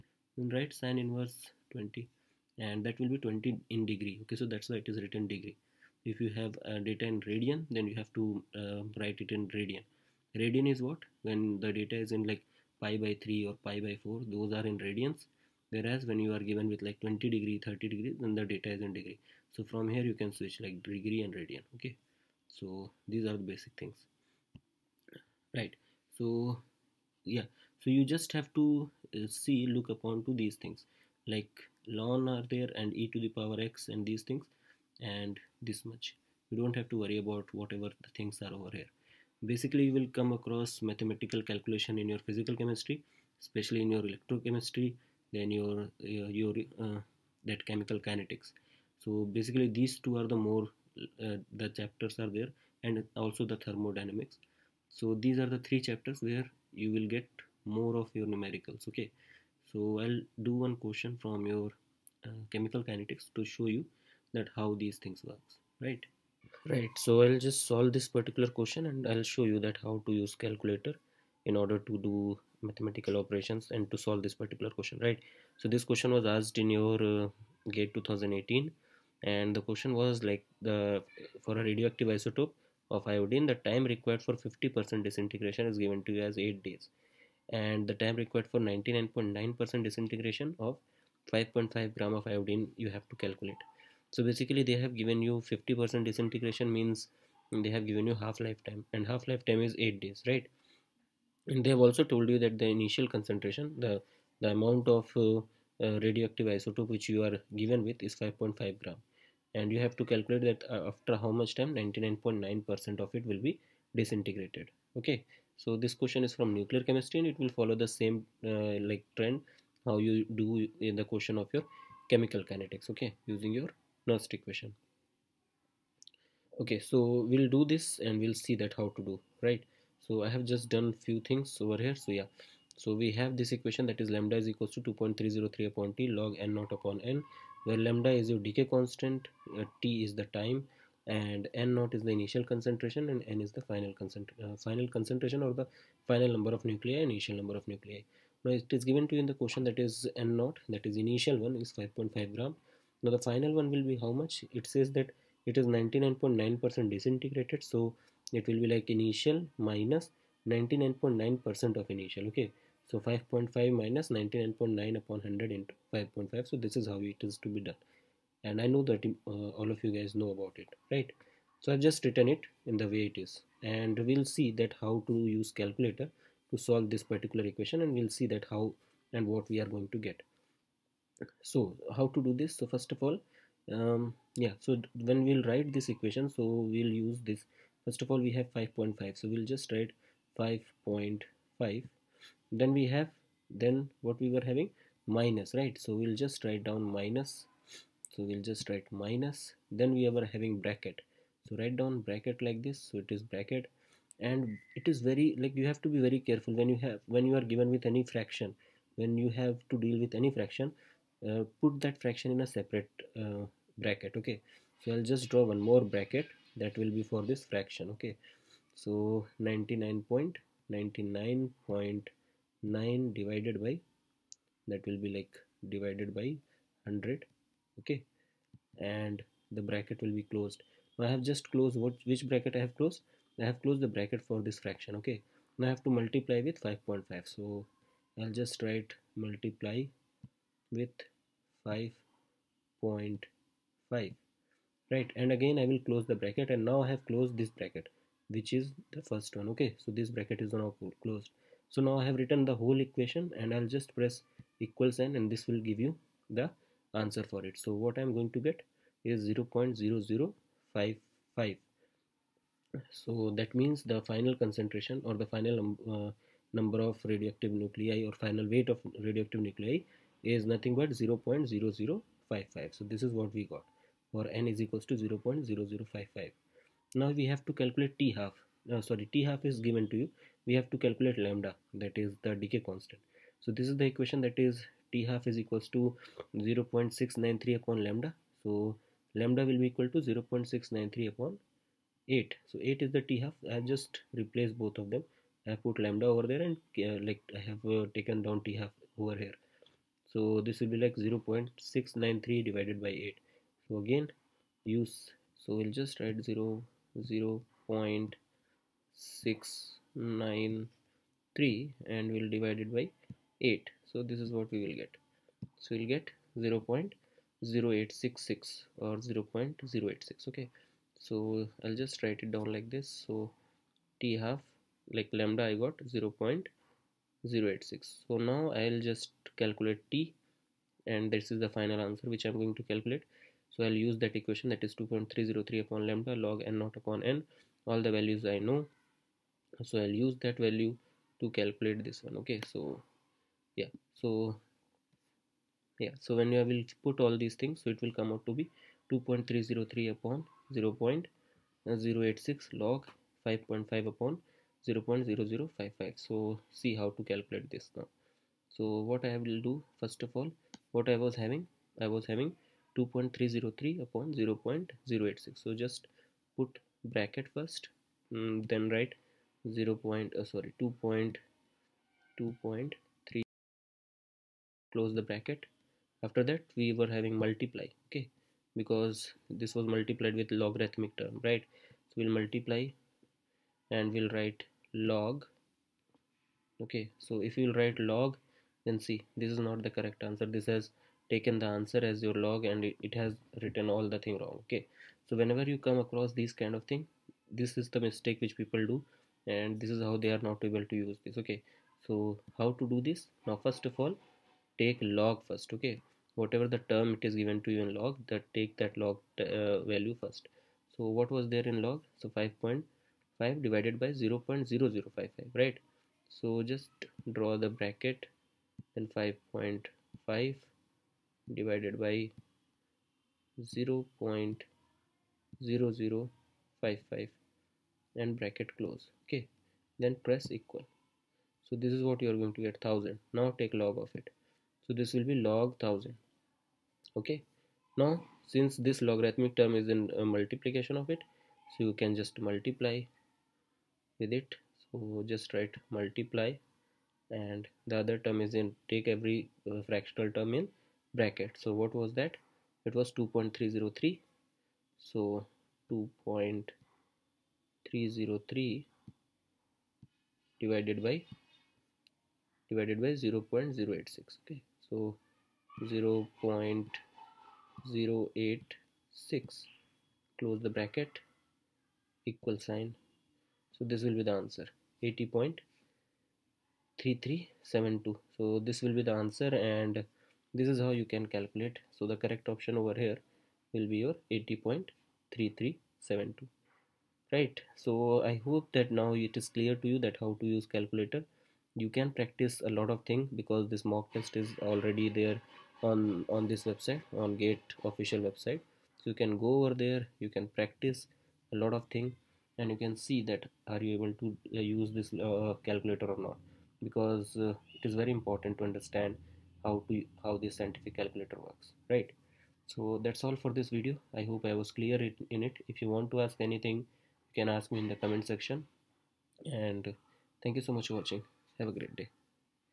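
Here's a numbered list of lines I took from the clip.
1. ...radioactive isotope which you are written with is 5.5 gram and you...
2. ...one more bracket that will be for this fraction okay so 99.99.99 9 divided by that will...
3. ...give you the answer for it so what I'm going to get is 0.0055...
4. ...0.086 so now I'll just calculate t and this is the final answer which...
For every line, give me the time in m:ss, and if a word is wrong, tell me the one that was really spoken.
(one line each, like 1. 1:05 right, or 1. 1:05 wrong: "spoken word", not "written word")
1. 1:46 wrong: "given", not "written"
2. 3:35 right
3. 4:15 right
4. 5:26 right.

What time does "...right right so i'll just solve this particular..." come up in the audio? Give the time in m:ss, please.
1:05.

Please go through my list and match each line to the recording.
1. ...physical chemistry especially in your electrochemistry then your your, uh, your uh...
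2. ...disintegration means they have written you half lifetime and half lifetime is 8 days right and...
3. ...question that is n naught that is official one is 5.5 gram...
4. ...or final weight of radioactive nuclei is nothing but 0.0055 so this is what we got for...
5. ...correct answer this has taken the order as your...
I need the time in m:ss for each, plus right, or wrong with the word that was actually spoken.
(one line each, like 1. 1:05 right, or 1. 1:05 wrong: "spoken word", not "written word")
1. 0:42 right
2. 1:36 wrong: "given", not "written"
3. 2:29 wrong: "initial", not "official"
4. 4:28 right
5. 6:29 wrong: "answer", not "order".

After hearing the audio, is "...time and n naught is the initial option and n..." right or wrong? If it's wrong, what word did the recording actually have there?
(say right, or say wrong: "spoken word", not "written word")
wrong: "concentration", not "option".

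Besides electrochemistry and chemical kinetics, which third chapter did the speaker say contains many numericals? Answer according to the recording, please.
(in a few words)
Thermodynamics.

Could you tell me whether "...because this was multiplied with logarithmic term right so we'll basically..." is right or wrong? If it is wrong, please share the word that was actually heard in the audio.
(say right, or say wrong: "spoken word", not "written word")
wrong: "multiply", not "basically".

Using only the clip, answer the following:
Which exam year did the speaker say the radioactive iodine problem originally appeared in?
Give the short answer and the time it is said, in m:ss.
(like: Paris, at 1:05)
2018, at 1:17.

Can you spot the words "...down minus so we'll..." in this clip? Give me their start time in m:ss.
3:16.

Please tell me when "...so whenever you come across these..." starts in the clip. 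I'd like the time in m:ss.
6:35.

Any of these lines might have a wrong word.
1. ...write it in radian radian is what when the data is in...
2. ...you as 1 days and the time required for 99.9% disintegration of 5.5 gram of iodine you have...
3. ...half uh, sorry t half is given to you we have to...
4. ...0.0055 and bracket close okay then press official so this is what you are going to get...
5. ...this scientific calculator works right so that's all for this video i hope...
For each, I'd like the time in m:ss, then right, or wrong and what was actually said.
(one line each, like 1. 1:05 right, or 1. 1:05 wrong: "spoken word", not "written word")
1. 0:09 right
2. 1:26 wrong: "8", not "1"
3. 4:38 right
4. 7:03 wrong: "equal", not "official"
5. 8:30 right.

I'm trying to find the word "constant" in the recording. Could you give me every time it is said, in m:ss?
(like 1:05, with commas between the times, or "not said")
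2:18, 4:42.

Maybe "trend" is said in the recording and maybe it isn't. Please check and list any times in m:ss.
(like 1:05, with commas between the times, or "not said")
1:59.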